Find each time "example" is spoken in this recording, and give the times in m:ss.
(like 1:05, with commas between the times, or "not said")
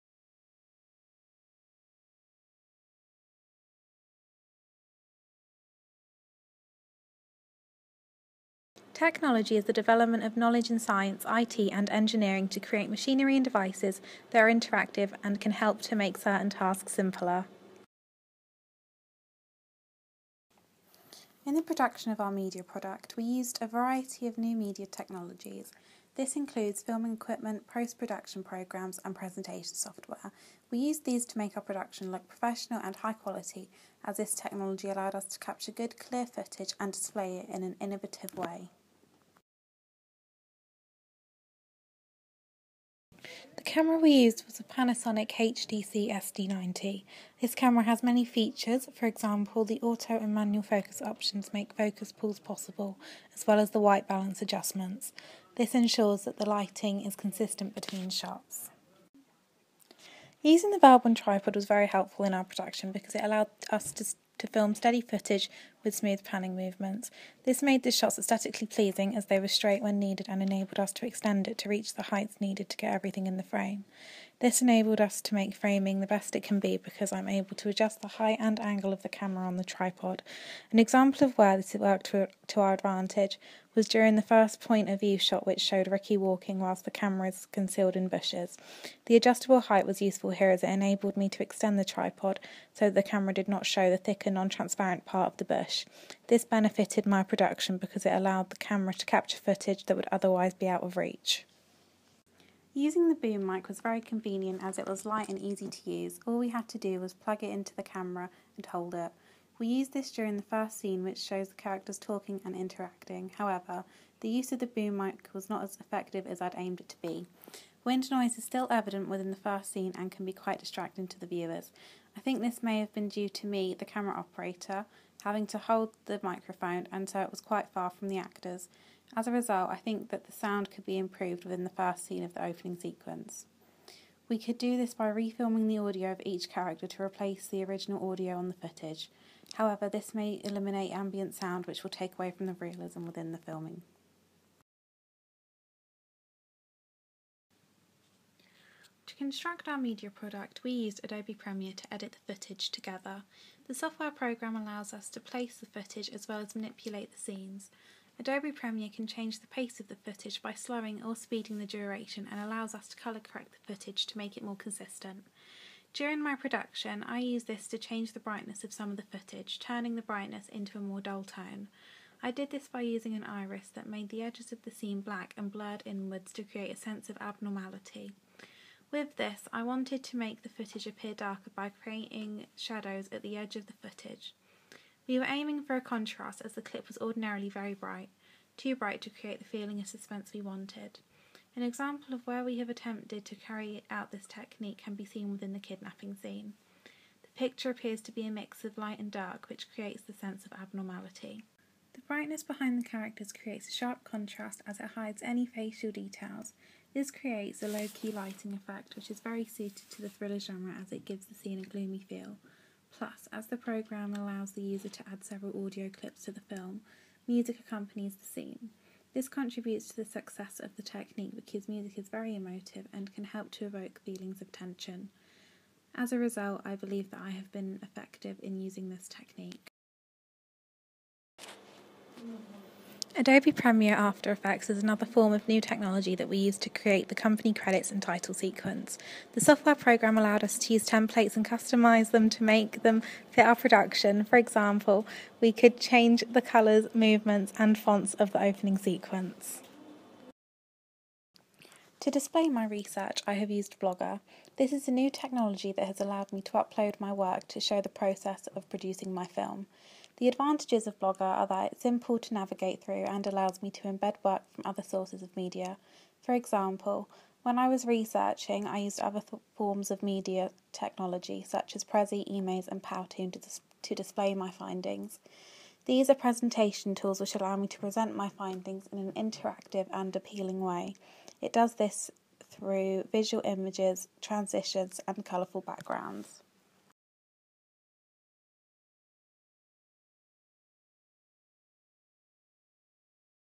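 0:49, 1:20, 3:11, 4:04, 4:26.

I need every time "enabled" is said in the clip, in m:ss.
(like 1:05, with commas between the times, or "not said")
1:10, 1:14, 1:30.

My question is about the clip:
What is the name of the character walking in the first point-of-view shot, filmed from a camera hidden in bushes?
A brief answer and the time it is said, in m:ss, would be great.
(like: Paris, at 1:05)
Ricky, at 1:25.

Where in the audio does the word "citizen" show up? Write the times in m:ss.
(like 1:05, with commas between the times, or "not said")
not said.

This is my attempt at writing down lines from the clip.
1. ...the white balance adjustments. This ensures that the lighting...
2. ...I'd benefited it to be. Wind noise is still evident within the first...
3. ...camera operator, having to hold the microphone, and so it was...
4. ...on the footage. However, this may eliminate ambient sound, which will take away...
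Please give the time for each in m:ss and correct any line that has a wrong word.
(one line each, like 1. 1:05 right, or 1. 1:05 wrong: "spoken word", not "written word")
1. 0:53 right
2. 1:56 wrong: "aimed", not "benefited"
3. 2:03 right
4. 2:18 right.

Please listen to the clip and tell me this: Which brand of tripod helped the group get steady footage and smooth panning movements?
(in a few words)
Velbon.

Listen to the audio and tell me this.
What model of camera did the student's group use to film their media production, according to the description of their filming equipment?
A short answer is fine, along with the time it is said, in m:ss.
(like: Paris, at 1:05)
Panasonic HDC SD90, at 0:44.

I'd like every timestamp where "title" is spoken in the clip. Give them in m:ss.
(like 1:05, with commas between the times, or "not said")
3:58.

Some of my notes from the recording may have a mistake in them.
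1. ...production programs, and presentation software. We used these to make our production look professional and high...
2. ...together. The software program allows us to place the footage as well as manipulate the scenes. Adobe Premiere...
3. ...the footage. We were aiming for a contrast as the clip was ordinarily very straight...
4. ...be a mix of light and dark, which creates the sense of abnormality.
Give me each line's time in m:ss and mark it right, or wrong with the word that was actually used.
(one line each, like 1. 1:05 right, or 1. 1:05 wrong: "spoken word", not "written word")
1. 0:27 right
2. 2:32 right
3. 3:03 wrong: "bright", not "straight"
4. 3:18 right.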